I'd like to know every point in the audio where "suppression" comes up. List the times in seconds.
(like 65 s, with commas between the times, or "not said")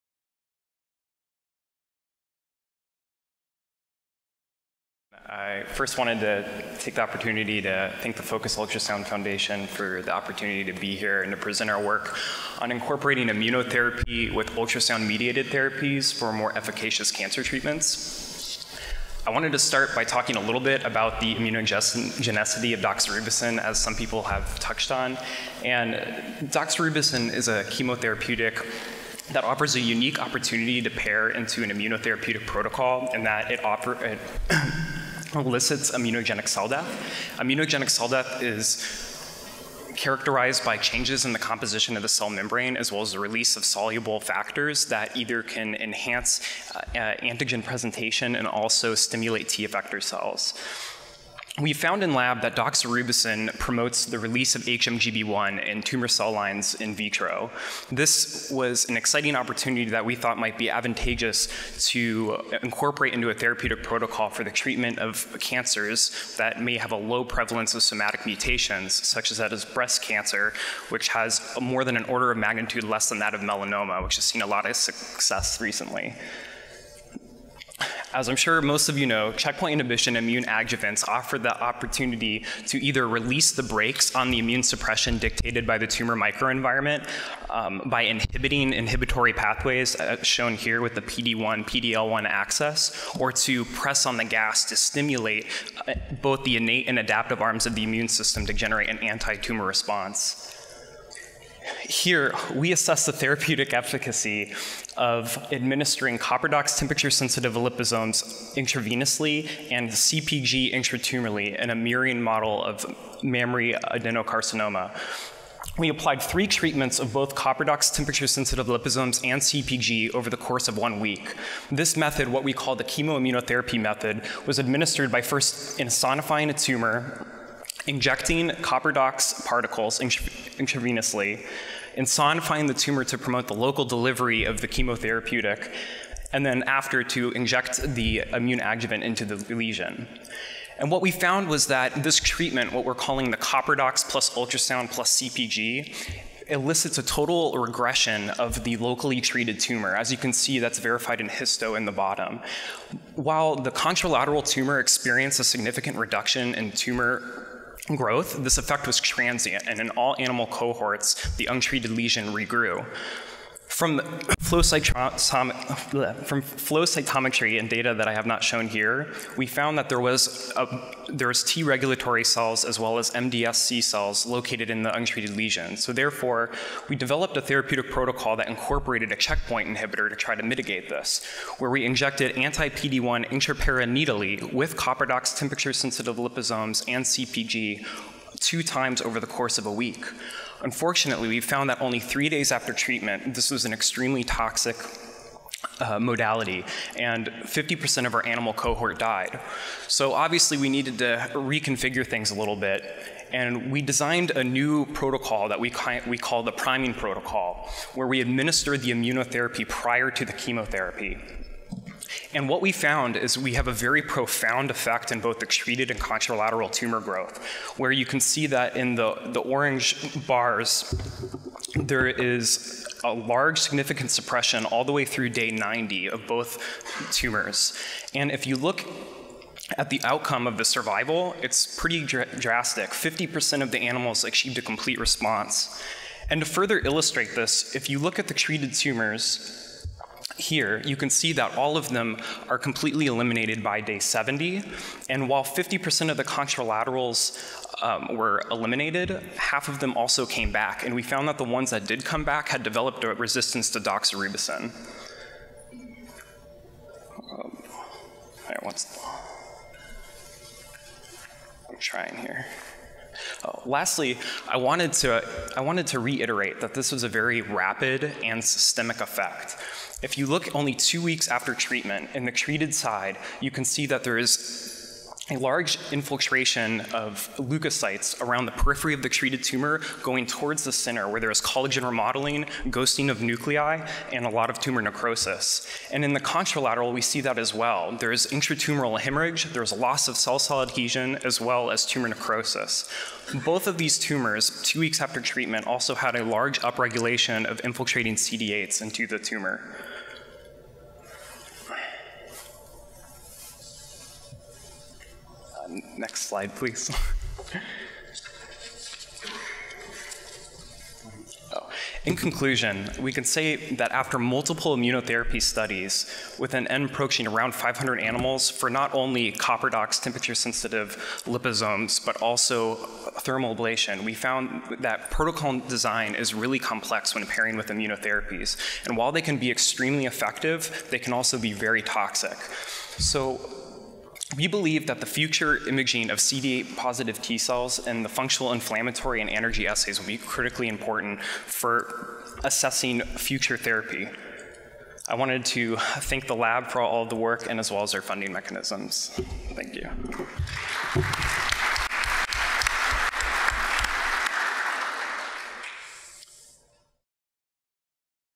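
84 s, 224 s.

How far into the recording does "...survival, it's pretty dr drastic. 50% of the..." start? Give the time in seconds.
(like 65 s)
230 s.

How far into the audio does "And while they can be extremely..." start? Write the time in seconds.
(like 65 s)
328 s.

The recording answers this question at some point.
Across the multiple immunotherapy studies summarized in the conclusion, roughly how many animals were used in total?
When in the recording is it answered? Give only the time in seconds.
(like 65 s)
317 s.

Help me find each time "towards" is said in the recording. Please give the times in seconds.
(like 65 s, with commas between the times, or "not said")
280 s.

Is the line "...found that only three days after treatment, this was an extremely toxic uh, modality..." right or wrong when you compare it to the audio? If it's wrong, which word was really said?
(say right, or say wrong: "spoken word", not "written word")
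right.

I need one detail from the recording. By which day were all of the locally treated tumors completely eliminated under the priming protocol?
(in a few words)
day 70.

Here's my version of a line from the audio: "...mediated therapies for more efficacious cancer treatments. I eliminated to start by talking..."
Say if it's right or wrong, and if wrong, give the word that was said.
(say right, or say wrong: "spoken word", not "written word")
wrong: "wanted", not "eliminated".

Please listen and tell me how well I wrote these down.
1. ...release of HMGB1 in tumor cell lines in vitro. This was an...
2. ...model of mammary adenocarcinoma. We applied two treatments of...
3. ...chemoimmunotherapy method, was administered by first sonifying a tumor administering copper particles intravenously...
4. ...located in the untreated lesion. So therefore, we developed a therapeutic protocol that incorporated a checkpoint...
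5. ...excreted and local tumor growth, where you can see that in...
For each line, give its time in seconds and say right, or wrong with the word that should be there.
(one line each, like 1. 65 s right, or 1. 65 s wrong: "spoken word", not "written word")
1. 54 s right
2. 112 s wrong: "three", not "two"
3. 122 s wrong: "injecting", not "administering"
4. 174 s right
5. 215 s wrong: "contralateral", not "local".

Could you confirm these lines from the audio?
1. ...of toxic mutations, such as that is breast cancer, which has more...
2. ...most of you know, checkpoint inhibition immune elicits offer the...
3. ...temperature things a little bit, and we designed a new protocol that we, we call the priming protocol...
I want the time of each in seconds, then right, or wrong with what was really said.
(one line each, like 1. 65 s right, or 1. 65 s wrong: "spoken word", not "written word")
1. 67 s wrong: "somatic", not "toxic"
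2. 78 s wrong: "adjuvants", not "elicits"
3. 201 s wrong: "reconfigure", not "temperature".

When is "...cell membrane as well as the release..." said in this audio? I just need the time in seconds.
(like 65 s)
42 s.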